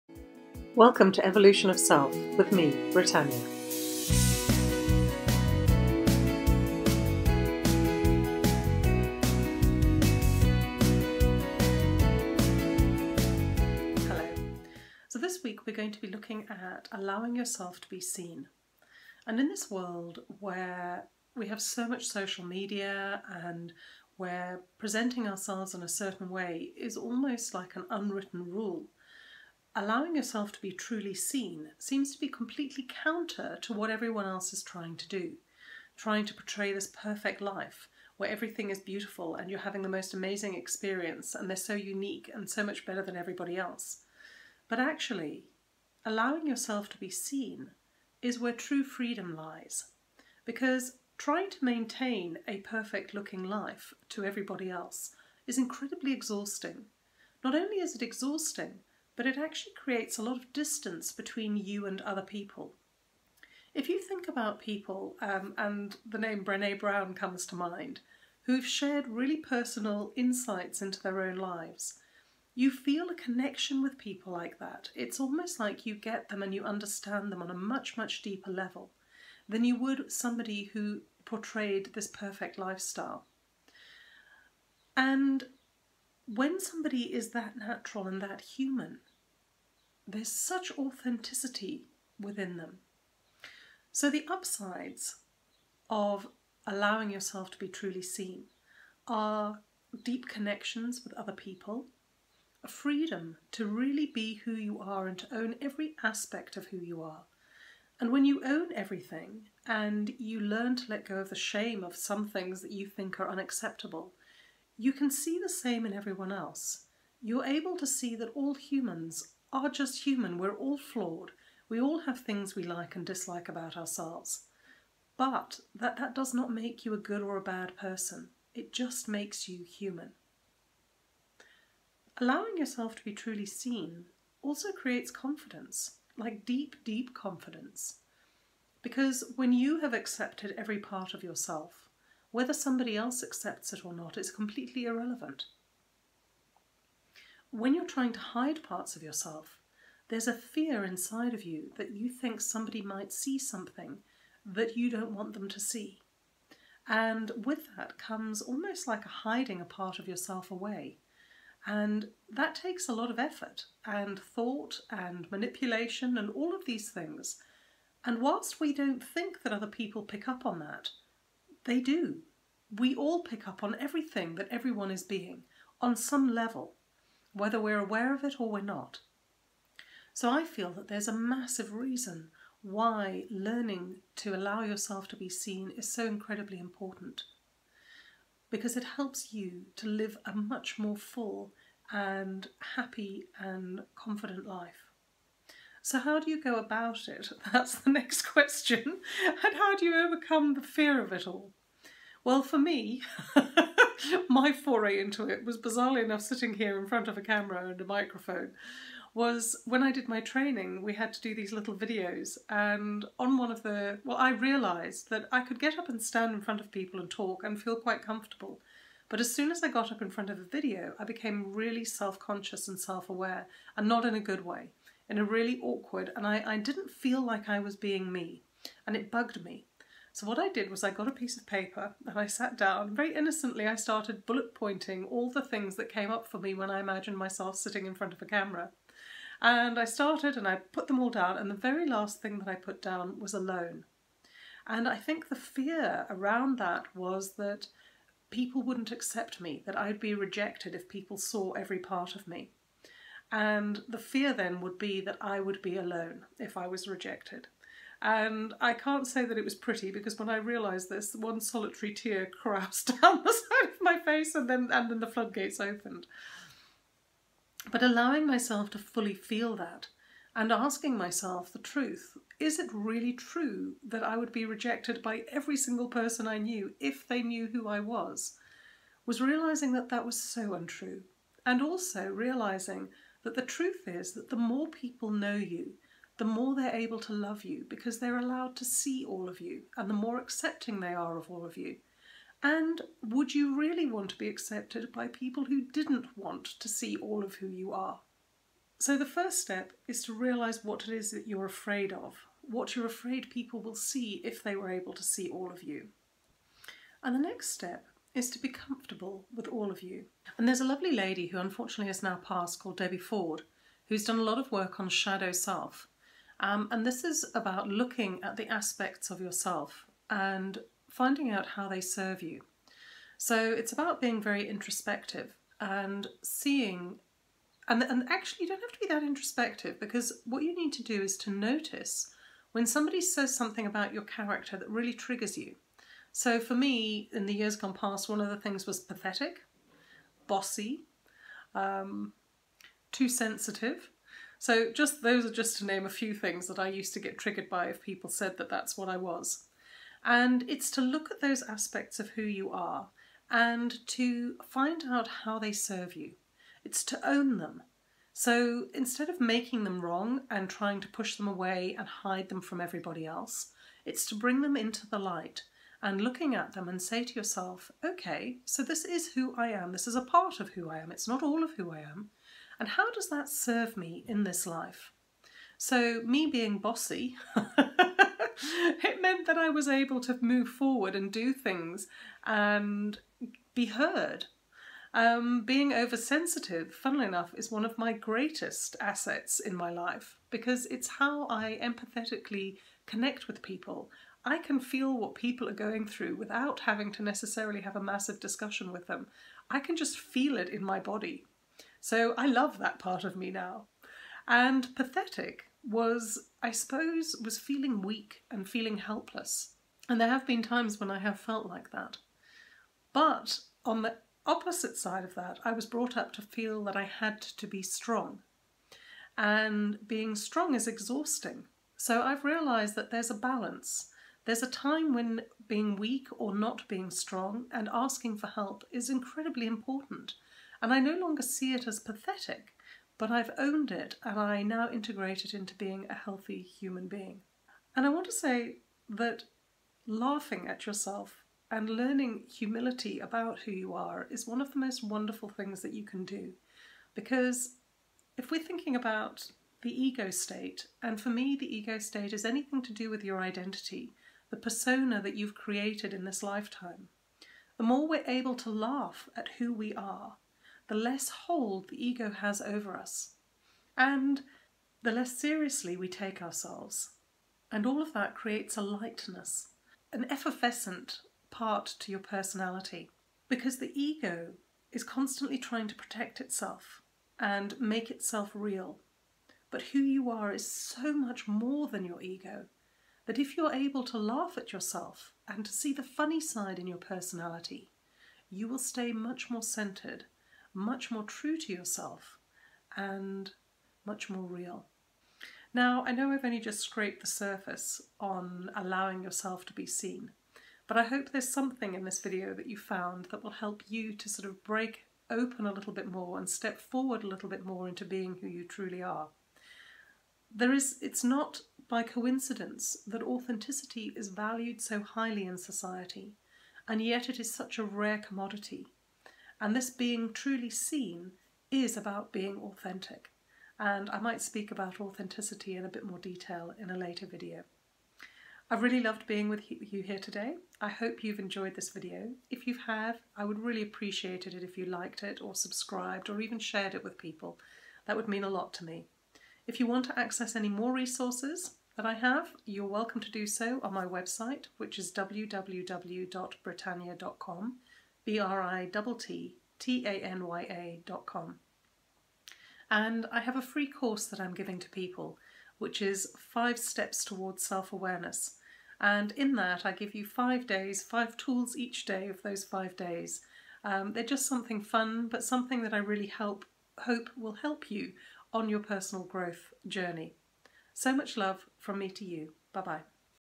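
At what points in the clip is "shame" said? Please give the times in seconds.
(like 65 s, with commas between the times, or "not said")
111 s.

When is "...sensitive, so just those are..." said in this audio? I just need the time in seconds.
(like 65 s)
343 s.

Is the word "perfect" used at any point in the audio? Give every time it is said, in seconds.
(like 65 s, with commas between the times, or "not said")
36 s, 52 s, 82 s.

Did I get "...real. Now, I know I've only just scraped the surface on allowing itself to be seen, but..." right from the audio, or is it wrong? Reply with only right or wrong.
wrong.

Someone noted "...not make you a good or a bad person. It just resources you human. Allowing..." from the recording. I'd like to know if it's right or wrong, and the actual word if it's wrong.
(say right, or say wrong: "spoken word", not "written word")
wrong: "makes", not "resources".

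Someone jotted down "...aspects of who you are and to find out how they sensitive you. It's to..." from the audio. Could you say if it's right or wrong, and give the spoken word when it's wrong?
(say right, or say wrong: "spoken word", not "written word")
wrong: "serve", not "sensitive".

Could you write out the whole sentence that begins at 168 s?
And whilst we don't think that other people pick up on that, they do.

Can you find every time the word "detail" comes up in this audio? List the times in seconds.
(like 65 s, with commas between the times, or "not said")
525 s.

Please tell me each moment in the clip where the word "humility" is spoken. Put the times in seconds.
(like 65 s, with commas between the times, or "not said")
442 s.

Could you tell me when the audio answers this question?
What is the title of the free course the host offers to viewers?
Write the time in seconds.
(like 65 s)
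556 s.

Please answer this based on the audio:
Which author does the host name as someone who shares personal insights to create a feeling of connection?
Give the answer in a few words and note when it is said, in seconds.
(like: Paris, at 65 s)
Brene Brown, at 66 s.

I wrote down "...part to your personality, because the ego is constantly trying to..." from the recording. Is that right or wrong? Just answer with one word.
right.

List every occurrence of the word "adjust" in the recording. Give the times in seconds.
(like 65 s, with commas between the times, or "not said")
not said.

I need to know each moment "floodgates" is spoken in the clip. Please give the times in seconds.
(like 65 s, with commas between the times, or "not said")
265 s.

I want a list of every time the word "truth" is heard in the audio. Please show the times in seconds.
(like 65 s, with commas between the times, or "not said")
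271 s, 283 s.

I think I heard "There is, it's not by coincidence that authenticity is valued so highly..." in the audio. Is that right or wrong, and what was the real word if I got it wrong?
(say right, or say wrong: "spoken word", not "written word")
right.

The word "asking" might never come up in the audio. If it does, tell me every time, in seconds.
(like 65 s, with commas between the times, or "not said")
270 s, 427 s.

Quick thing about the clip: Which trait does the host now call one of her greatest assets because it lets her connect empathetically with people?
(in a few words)
being oversensitive.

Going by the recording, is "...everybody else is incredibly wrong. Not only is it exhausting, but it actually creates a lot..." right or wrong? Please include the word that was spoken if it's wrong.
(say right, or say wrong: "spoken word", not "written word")
wrong: "exhausting", not "wrong".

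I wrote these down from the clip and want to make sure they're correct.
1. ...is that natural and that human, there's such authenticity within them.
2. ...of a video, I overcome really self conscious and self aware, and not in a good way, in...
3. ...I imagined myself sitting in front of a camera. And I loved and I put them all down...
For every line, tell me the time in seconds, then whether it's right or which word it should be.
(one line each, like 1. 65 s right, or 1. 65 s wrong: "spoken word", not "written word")
1. 87 s right
2. 220 s wrong: "became", not "overcome"
3. 236 s wrong: "started", not "loved".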